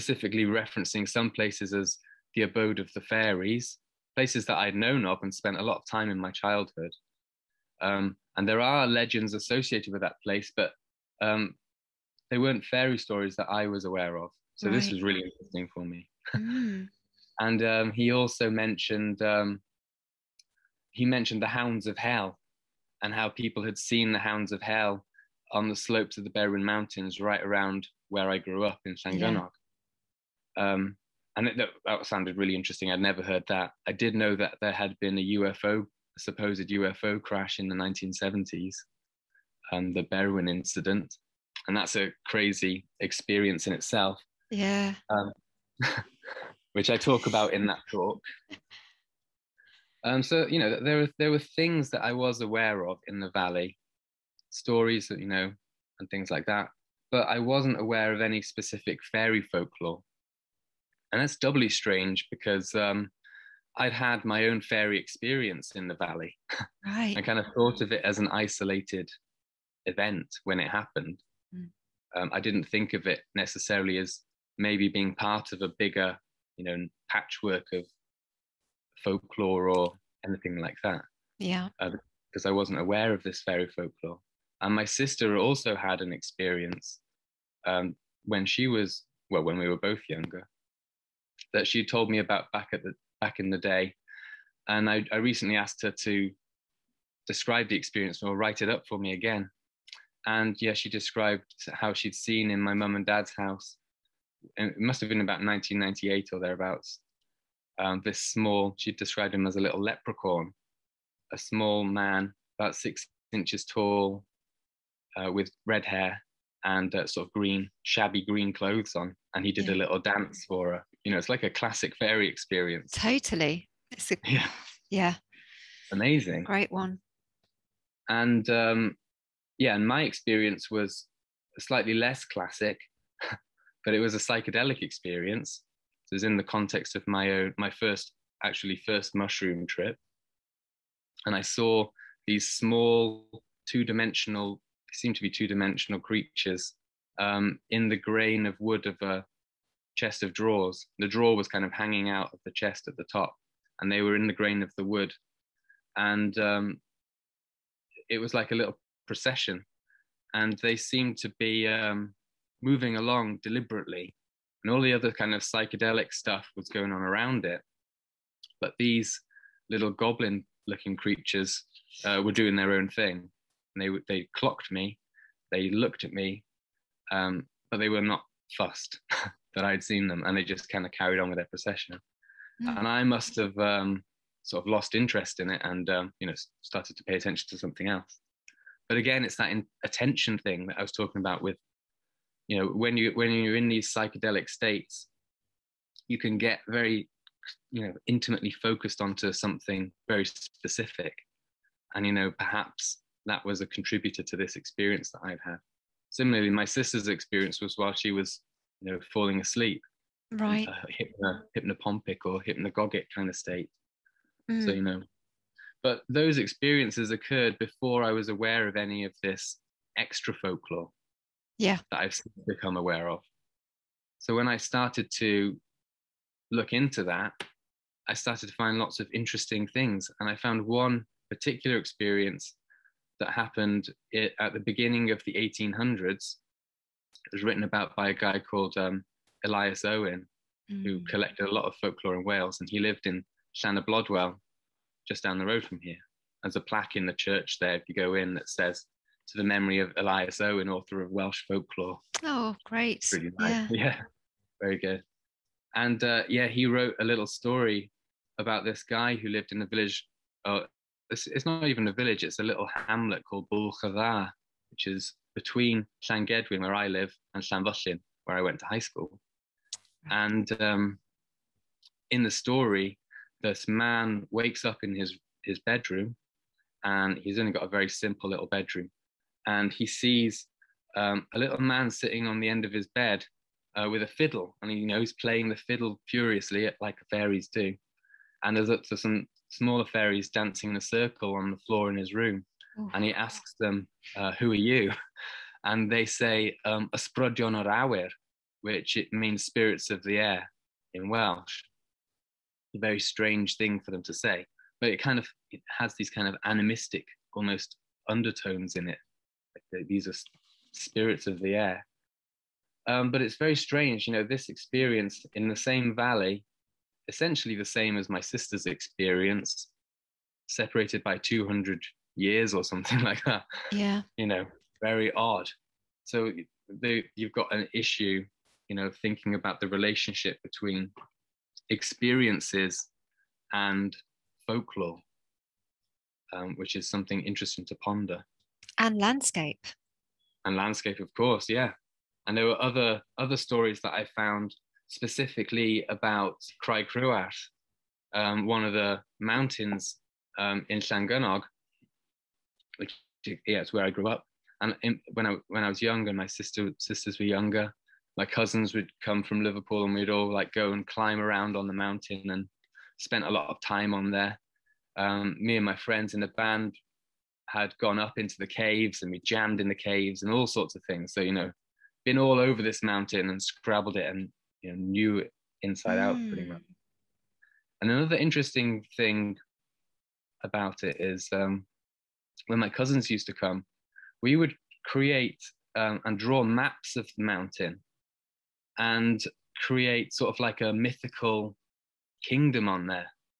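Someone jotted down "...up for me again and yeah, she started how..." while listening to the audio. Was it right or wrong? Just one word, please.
wrong.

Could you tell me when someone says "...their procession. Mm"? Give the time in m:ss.
3:01.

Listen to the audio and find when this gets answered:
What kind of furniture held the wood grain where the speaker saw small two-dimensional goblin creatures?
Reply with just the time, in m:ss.
2:29.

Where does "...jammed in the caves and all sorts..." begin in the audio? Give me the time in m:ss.
6:09.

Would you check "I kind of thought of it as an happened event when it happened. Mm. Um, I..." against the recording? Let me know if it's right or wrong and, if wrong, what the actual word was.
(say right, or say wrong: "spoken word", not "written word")
wrong: "isolated", not "happened".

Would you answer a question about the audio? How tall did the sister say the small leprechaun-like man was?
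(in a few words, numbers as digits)
6 inches.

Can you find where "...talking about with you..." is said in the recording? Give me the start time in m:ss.
3:10.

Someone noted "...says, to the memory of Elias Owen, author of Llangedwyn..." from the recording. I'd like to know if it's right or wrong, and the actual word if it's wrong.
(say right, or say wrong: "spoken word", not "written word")
wrong: "Welsh", not "Llangedwyn".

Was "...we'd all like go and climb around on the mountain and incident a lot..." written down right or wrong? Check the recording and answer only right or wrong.
wrong.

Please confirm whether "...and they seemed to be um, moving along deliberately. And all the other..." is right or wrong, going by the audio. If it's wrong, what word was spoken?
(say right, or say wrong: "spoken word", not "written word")
right.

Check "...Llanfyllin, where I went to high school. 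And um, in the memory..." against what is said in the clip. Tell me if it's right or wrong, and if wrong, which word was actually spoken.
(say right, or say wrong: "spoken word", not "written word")
wrong: "story", not "memory".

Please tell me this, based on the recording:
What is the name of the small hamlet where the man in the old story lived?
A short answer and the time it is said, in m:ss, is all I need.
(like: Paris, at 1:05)
Bwlch-y-ddar, at 4:23.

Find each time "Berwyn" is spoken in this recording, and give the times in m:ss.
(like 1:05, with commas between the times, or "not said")
0:26, 0:40.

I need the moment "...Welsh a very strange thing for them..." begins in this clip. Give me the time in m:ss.
5:01.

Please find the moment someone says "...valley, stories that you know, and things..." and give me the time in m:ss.
0:53.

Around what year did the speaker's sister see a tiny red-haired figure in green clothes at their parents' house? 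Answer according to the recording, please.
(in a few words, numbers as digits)
1998.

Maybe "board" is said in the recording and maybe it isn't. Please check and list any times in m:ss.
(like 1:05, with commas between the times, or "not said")
not said.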